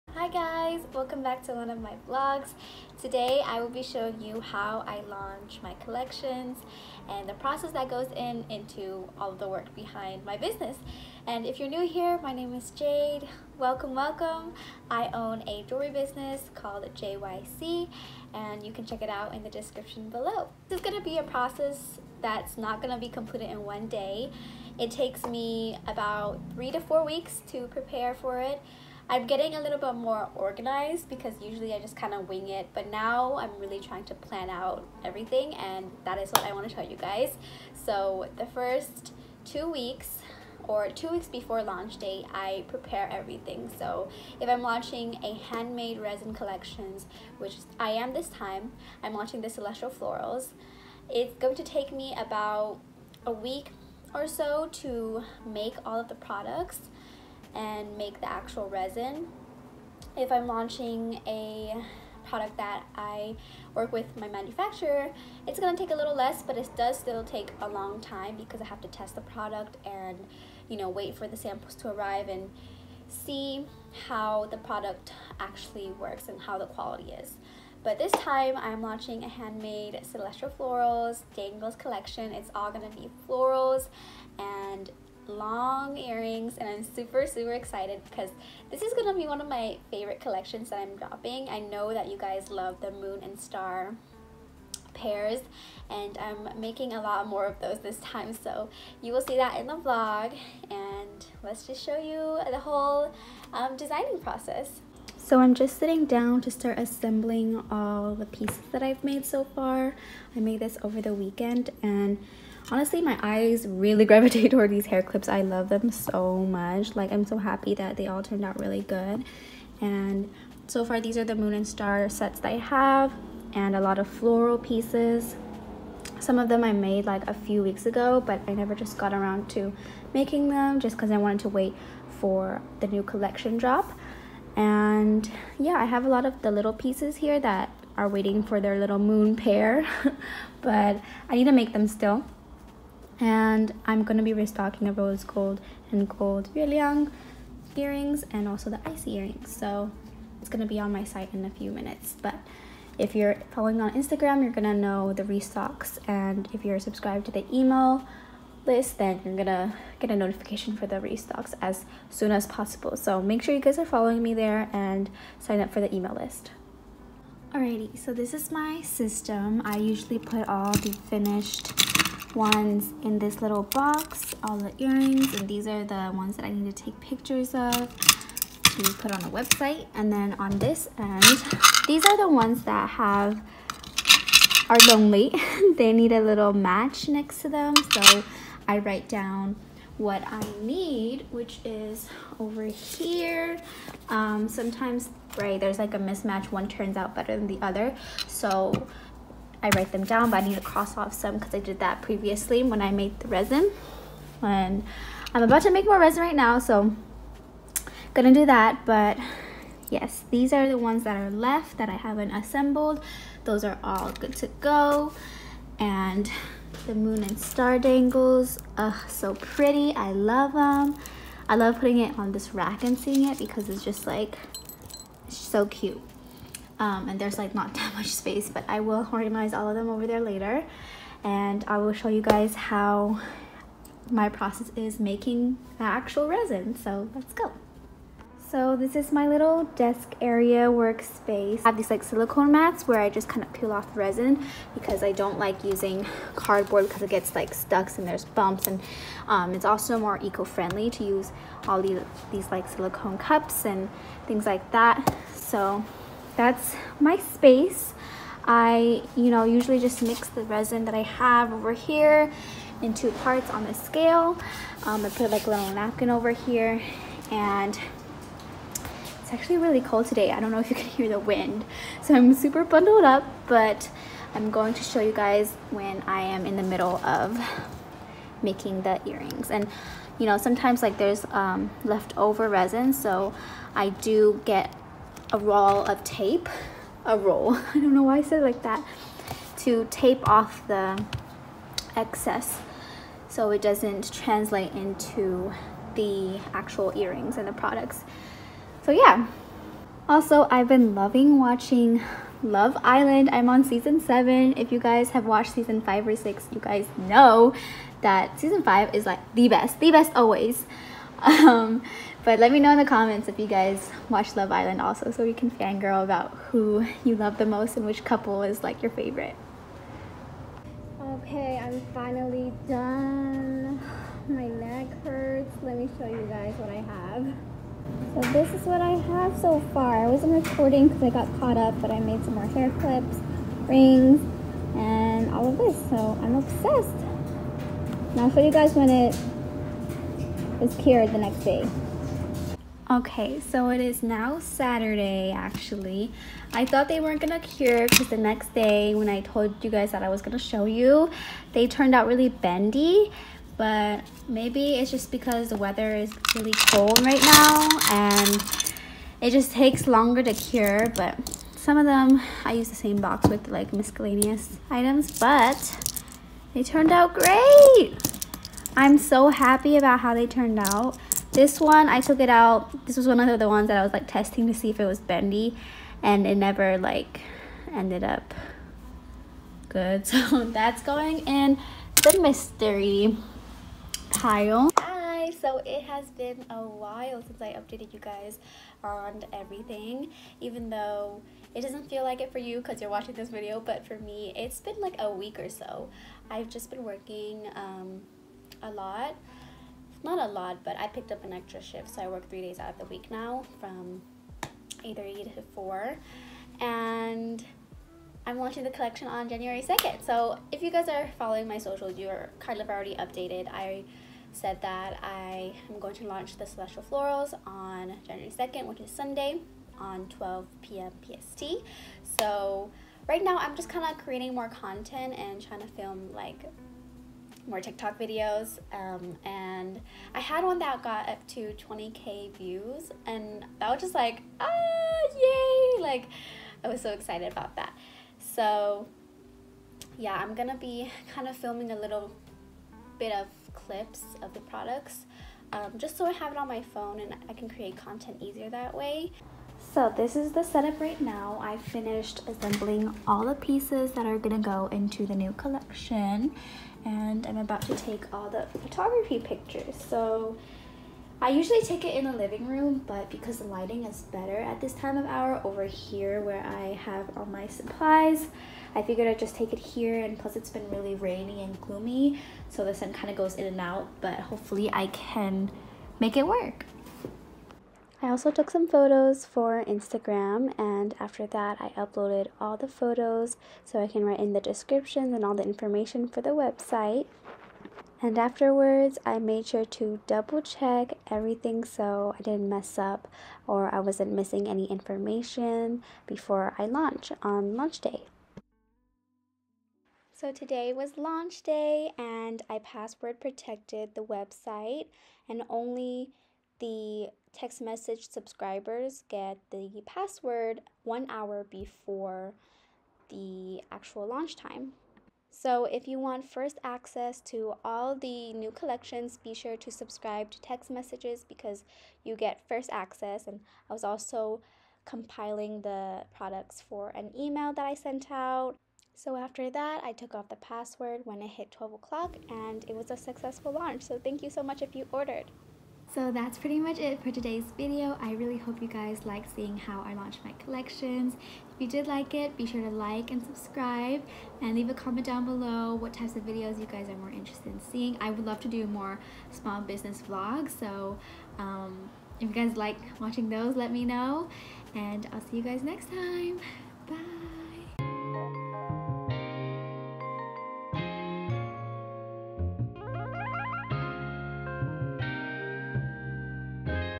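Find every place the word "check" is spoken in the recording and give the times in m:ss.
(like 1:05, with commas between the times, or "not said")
0:18, 8:10.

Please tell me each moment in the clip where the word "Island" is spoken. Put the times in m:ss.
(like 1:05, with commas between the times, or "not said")
5:02, 5:14.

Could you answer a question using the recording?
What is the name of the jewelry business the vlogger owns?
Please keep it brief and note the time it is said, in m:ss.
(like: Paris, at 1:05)
JYC, at 0:16.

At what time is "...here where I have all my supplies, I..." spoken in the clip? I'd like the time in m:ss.
7:45.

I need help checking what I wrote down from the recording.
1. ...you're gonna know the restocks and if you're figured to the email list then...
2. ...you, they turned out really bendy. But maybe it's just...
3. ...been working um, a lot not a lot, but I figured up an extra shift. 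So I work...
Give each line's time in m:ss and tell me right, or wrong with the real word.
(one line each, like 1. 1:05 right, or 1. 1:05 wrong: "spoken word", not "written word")
1. 2:34 wrong: "subscribed", not "figured"
2. 5:50 right
3. 6:36 wrong: "picked", not "figured".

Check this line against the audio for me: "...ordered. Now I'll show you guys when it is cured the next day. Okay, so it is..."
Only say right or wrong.
wrong.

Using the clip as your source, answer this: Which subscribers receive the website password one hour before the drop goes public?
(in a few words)
text message subscribers.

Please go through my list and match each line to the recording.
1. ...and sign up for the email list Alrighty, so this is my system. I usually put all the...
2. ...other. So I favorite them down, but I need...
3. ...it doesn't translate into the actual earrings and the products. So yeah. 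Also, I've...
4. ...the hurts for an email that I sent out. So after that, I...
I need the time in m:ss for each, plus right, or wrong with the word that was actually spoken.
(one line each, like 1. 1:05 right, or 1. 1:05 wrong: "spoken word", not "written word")
1. 2:44 right
2. 3:17 wrong: "write", not "favorite"
3. 4:53 right
4. 8:45 wrong: "products", not "hurts".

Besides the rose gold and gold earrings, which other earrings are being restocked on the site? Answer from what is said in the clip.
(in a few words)
icy earrings.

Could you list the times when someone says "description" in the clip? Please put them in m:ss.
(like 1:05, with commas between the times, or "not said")
0:19, 8:04.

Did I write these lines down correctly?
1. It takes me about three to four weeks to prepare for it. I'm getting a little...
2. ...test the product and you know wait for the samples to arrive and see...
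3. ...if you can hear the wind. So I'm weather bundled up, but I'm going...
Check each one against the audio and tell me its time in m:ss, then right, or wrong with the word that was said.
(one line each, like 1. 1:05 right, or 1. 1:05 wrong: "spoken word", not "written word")
1. 0:24 right
2. 1:08 right
3. 4:30 wrong: "super", not "weather".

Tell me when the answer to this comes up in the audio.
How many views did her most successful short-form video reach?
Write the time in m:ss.
7:11.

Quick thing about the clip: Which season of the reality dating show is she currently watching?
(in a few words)
season 7.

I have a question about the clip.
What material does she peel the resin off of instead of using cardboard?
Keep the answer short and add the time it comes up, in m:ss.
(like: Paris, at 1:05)
silicone mats, at 4:02.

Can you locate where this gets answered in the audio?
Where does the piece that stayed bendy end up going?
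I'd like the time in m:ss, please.
6:22.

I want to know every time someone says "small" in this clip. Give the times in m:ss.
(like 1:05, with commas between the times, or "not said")
9:09.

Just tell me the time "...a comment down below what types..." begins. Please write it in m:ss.
9:04.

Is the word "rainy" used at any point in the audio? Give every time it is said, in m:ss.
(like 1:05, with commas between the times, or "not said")
7:50.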